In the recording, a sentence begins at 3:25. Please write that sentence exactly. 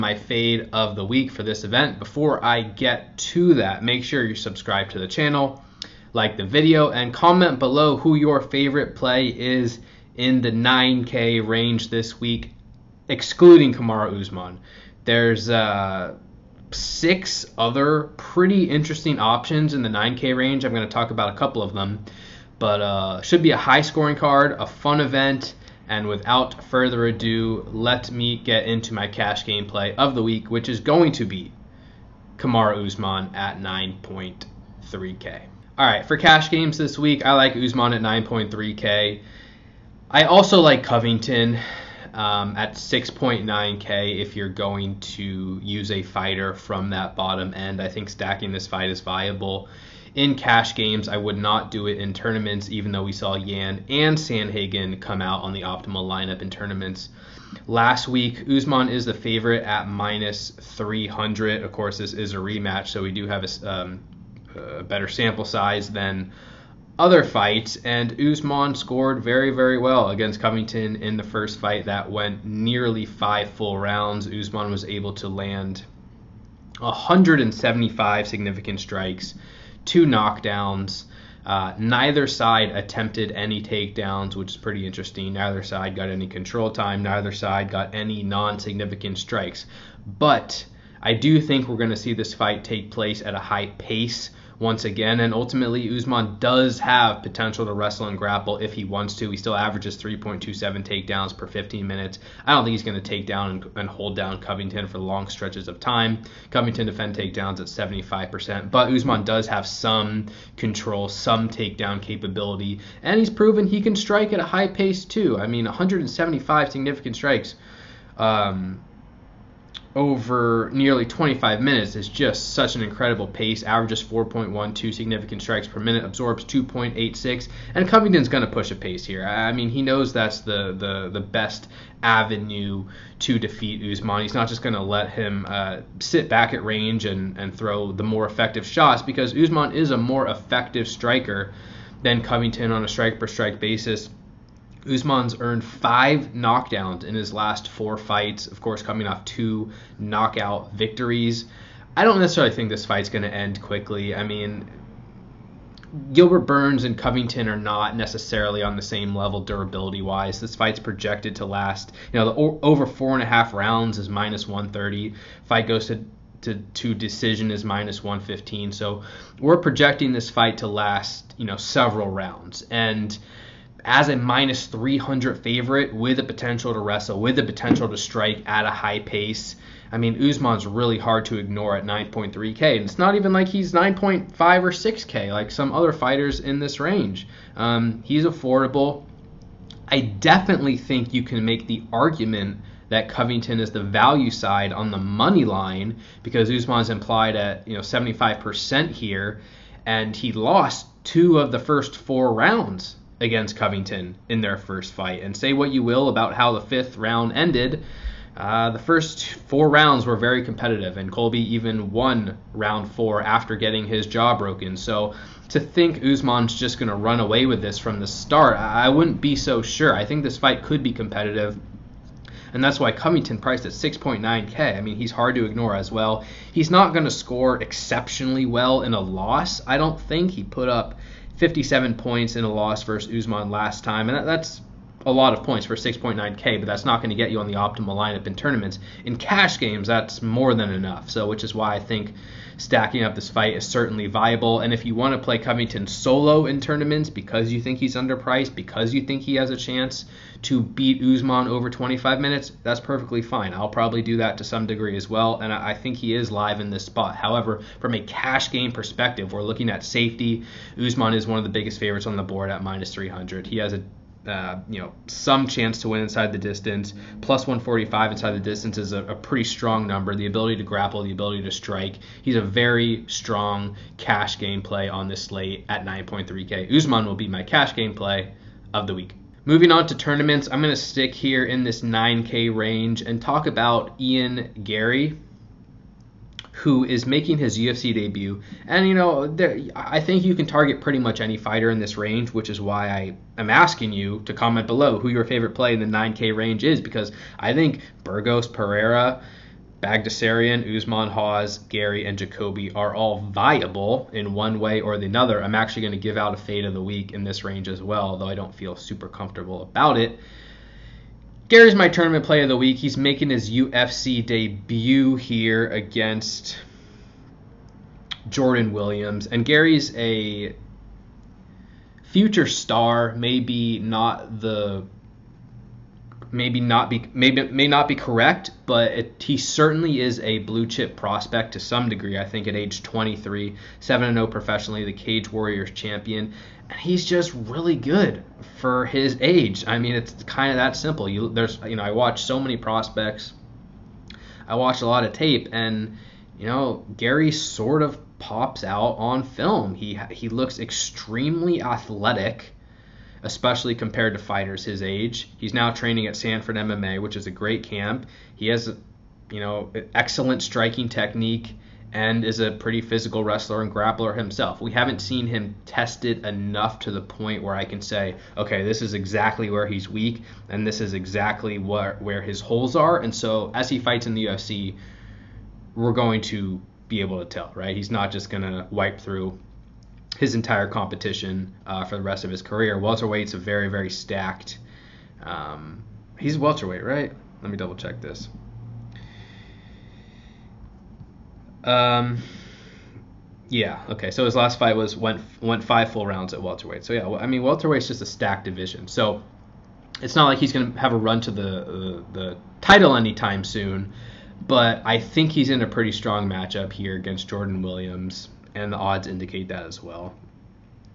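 And say what you will about how the fifth round ended.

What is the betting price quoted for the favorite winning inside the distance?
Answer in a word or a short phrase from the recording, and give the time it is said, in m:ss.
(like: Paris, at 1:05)
+145, at 4:27.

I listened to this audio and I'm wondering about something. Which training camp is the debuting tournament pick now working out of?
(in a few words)
Sanford MMA.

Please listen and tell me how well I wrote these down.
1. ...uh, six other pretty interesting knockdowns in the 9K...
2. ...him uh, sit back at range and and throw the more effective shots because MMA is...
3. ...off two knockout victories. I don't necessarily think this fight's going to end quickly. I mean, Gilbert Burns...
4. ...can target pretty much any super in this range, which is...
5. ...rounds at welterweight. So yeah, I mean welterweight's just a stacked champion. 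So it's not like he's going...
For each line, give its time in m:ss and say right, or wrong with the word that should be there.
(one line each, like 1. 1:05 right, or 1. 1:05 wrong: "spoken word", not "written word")
1. 0:15 wrong: "options", not "knockdowns"
2. 2:15 wrong: "Usman", not "MMA"
3. 2:29 right
4. 4:50 wrong: "fighter", not "super"
5. 6:36 wrong: "division", not "champion".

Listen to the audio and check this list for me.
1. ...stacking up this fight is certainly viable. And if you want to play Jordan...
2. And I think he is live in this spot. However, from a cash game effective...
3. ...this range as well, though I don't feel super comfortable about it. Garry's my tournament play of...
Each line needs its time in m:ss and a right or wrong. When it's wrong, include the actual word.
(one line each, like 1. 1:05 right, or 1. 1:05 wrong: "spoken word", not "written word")
1. 4:02 wrong: "Covington", not "Jordan"
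2. 4:15 wrong: "perspective", not "effective"
3. 5:07 right.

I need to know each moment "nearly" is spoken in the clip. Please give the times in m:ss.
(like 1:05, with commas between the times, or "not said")
1:12, 2:00.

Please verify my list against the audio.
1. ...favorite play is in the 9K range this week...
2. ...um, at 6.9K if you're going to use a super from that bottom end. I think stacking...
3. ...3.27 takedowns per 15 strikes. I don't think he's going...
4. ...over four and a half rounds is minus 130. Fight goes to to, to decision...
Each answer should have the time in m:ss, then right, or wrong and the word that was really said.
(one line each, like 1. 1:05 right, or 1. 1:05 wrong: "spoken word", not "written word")
1. 0:08 right
2. 0:42 wrong: "fighter", not "super"
3. 1:39 wrong: "minutes", not "strikes"
4. 2:42 right.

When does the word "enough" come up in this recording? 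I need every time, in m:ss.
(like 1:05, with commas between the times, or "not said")
4:00, 6:06.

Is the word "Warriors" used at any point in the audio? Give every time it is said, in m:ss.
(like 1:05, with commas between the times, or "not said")
5:35.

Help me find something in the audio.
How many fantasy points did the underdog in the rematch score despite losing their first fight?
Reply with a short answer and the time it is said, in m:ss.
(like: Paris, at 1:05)
57, at 3:51.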